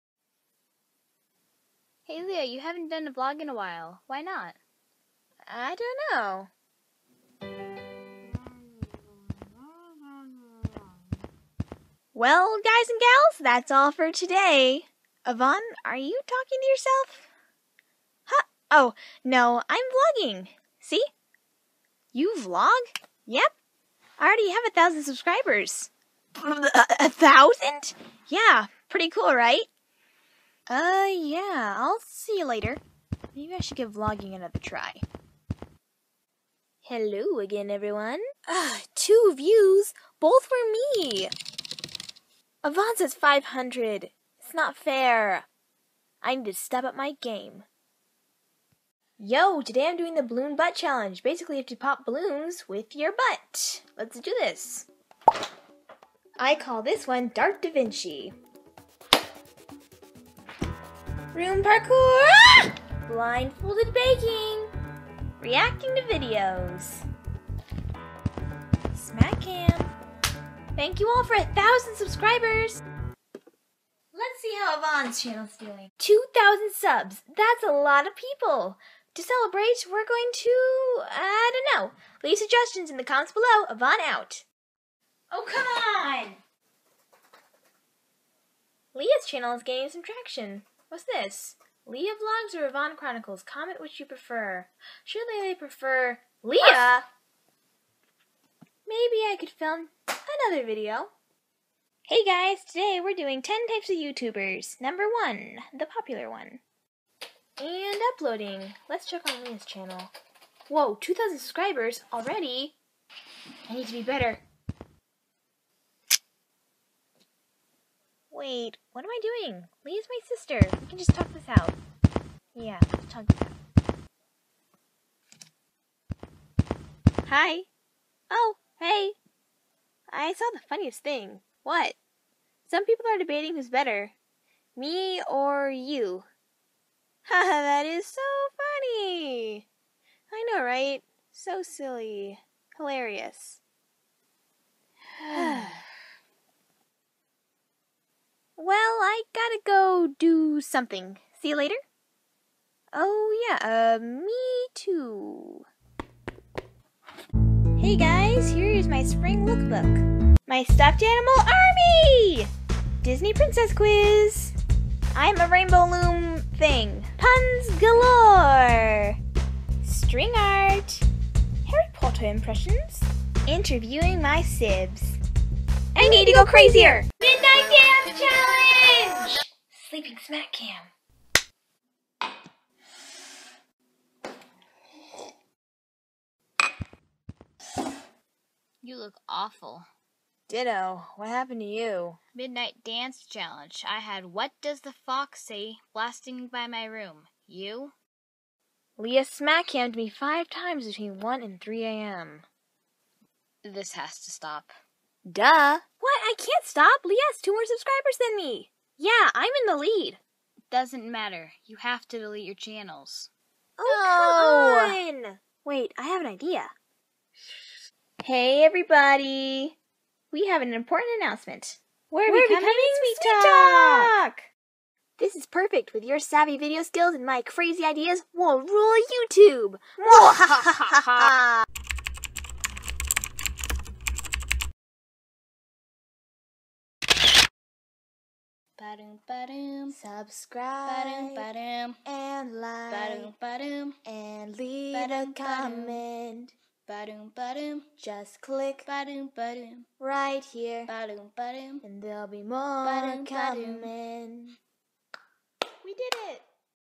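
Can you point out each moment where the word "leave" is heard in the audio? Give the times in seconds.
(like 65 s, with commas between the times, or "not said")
82 s, 244 s.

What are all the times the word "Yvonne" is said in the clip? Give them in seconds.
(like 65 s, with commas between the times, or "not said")
15 s, 92 s.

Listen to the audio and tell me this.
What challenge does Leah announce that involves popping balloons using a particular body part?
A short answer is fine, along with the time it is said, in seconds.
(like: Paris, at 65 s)
balloon butt challenge, at 50 s.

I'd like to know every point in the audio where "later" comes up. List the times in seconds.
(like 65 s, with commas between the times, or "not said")
32 s, 151 s.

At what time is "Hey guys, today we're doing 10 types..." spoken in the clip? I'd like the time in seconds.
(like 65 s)
102 s.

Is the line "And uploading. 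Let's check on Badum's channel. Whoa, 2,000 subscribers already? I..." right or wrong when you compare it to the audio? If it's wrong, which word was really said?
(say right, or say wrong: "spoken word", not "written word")
wrong: "Leah", not "Badum".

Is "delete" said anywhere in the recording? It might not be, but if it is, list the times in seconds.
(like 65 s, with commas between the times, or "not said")
212 s.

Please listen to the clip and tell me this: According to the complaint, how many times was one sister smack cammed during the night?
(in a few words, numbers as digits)
5.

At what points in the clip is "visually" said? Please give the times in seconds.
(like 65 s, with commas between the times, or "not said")
not said.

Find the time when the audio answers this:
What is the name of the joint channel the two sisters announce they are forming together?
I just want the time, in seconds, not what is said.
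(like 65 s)
223 s.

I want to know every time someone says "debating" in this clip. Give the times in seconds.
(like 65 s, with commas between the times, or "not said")
133 s.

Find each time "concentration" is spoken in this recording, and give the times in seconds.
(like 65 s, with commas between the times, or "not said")
not said.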